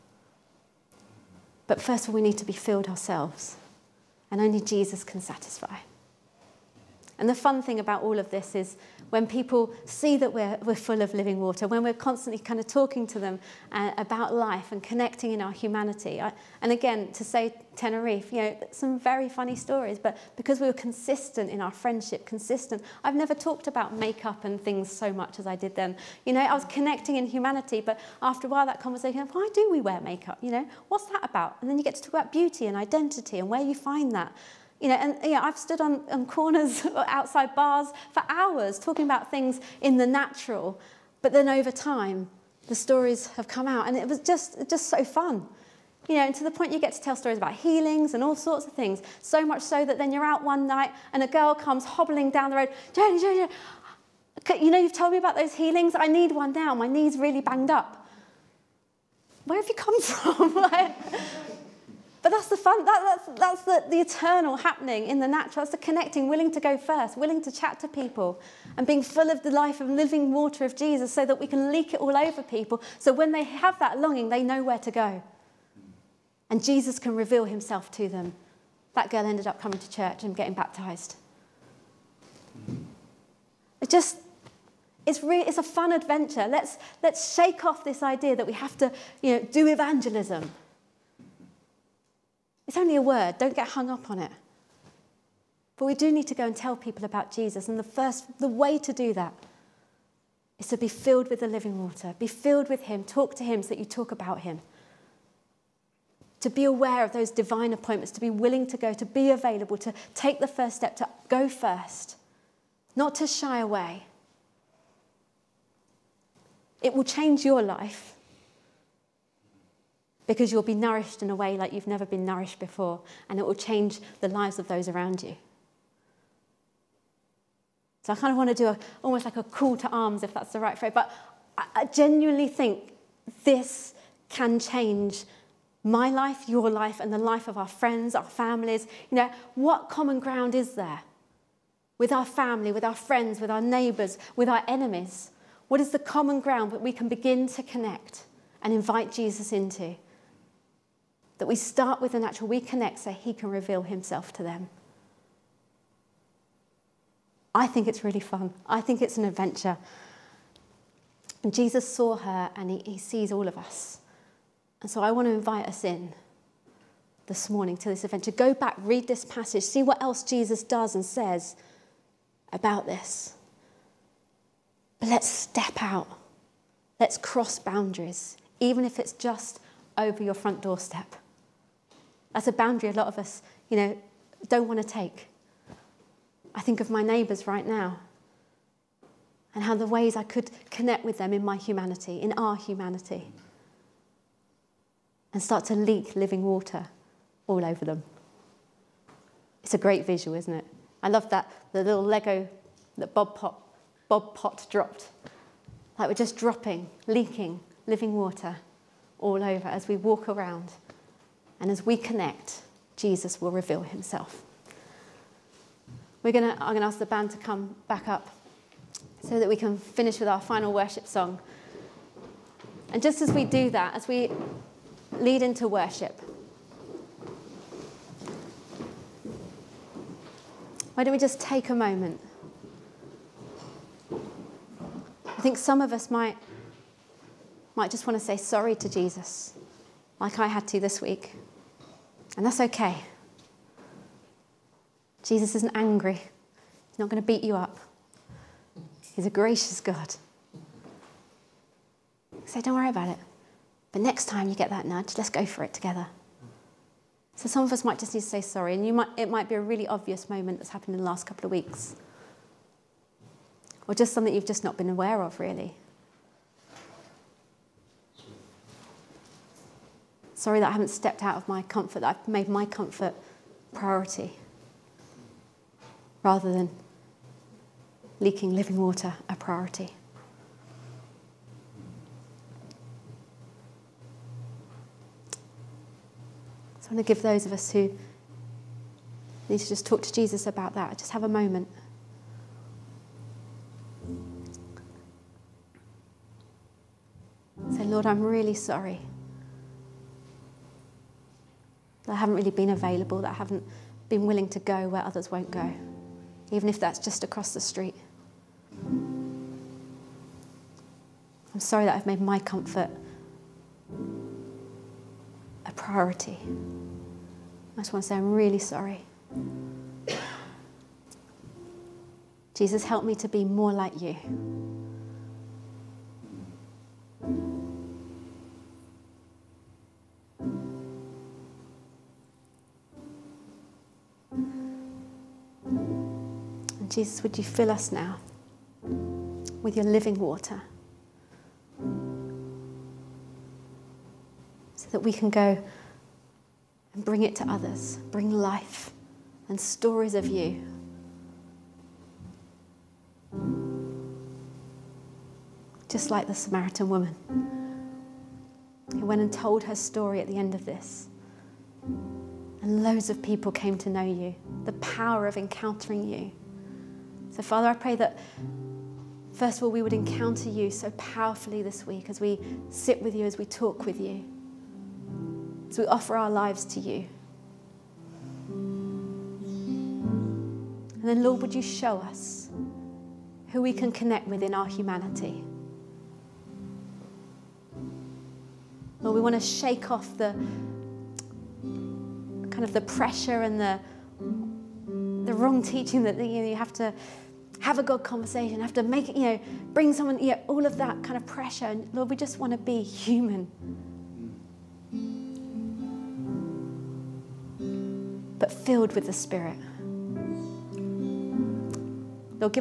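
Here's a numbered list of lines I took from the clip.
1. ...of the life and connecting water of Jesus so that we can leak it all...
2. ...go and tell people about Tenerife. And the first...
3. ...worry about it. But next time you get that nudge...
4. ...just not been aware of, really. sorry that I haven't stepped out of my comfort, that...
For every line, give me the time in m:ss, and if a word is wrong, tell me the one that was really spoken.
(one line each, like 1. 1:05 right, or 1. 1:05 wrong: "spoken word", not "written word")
1. 1:09 wrong: "living", not "connecting"
2. 1:36 wrong: "Jesus", not "Tenerife"
3. 4:12 right
4. 4:24 right.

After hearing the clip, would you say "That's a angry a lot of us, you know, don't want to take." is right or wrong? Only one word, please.
wrong.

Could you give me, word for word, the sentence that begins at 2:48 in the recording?
Go back, read this passage, see what else Jesus does and says about this.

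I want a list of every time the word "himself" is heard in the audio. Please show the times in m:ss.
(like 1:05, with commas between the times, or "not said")
1:17, 2:33, 3:33.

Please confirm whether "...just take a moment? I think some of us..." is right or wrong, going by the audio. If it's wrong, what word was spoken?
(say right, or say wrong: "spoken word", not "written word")
right.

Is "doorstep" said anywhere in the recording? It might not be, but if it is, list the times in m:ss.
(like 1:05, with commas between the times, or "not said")
3:00.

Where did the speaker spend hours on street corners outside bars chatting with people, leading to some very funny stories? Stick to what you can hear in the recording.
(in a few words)
Tenerife.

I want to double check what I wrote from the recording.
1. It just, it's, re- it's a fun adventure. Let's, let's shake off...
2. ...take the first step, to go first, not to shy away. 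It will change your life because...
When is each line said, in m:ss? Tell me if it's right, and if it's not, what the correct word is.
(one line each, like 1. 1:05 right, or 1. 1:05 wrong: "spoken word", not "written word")
1. 1:23 right
2. 1:50 right.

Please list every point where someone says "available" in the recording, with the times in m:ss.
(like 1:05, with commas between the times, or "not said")
1:49, 5:02.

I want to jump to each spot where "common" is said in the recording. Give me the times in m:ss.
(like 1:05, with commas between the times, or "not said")
2:19, 2:25.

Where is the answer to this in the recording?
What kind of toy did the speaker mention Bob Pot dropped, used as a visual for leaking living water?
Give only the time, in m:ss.
3:22.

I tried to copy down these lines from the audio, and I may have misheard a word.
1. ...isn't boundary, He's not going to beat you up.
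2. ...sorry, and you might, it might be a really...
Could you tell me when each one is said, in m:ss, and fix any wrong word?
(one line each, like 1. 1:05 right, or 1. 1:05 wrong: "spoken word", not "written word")
1. 4:05 wrong: "angry", not "boundary"
2. 4:18 right.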